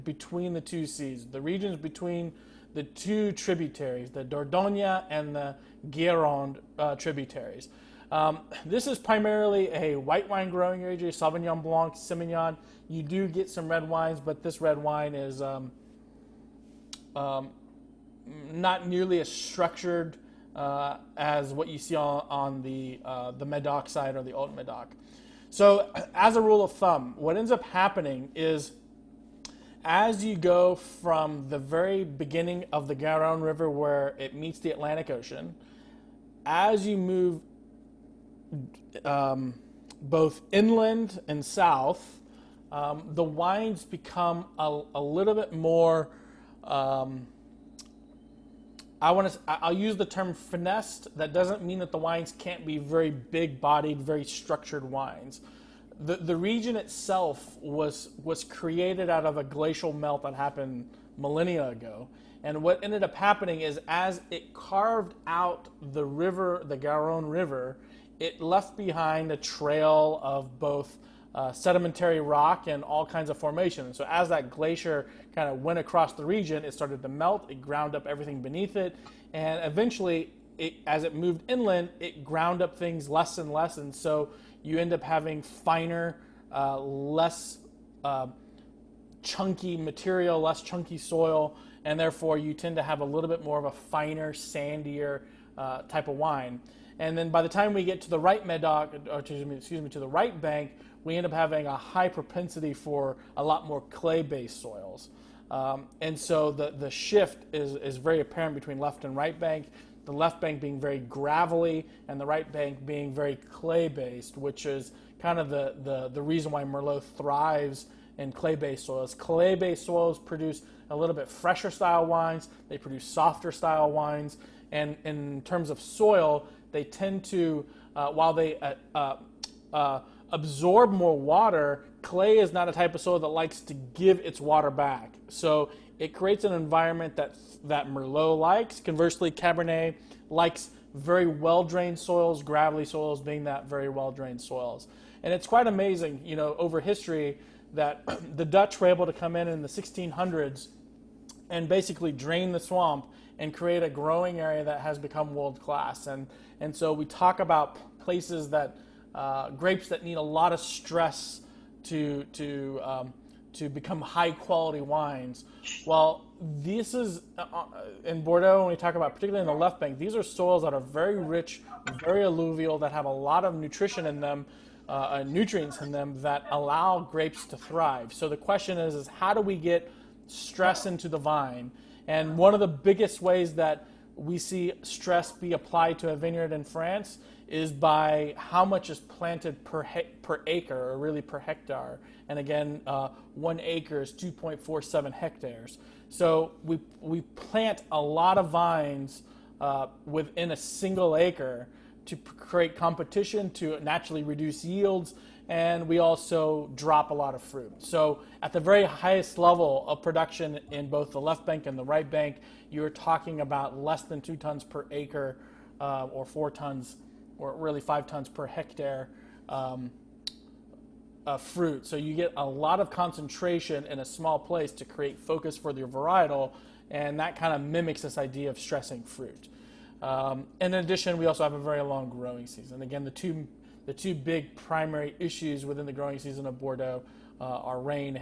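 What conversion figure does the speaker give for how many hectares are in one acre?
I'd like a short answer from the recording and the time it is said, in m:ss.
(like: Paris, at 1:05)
2.47, at 3:14.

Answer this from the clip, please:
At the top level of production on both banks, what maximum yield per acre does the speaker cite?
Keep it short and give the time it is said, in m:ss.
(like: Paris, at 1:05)
Less than 2 tons, at 3:33.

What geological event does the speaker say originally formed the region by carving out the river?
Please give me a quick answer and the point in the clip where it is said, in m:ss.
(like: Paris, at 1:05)
A glacial melt, at 0:59.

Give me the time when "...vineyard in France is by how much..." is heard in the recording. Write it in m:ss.
3:06.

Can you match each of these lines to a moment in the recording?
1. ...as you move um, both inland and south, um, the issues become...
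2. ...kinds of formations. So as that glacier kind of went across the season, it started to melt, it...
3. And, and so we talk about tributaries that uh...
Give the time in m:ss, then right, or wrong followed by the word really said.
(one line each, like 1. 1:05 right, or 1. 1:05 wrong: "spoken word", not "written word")
1. 0:36 wrong: "wines", not "issues"
2. 1:13 wrong: "region", not "season"
3. 2:36 wrong: "places", not "tributaries".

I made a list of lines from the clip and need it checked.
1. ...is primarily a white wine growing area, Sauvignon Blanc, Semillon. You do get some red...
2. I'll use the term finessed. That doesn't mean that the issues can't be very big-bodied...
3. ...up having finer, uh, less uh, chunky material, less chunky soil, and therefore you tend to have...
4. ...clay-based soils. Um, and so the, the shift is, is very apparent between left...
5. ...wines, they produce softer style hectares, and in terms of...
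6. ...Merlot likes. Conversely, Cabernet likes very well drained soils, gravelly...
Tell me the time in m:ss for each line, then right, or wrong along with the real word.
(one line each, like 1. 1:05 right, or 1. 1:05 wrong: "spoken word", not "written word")
1. 0:08 right
2. 0:49 wrong: "wines", not "issues"
3. 1:24 right
4. 1:43 right
5. 2:02 wrong: "wines", not "hectares"
6. 2:17 right.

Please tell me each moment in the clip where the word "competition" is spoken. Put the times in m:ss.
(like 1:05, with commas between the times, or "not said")
3:22.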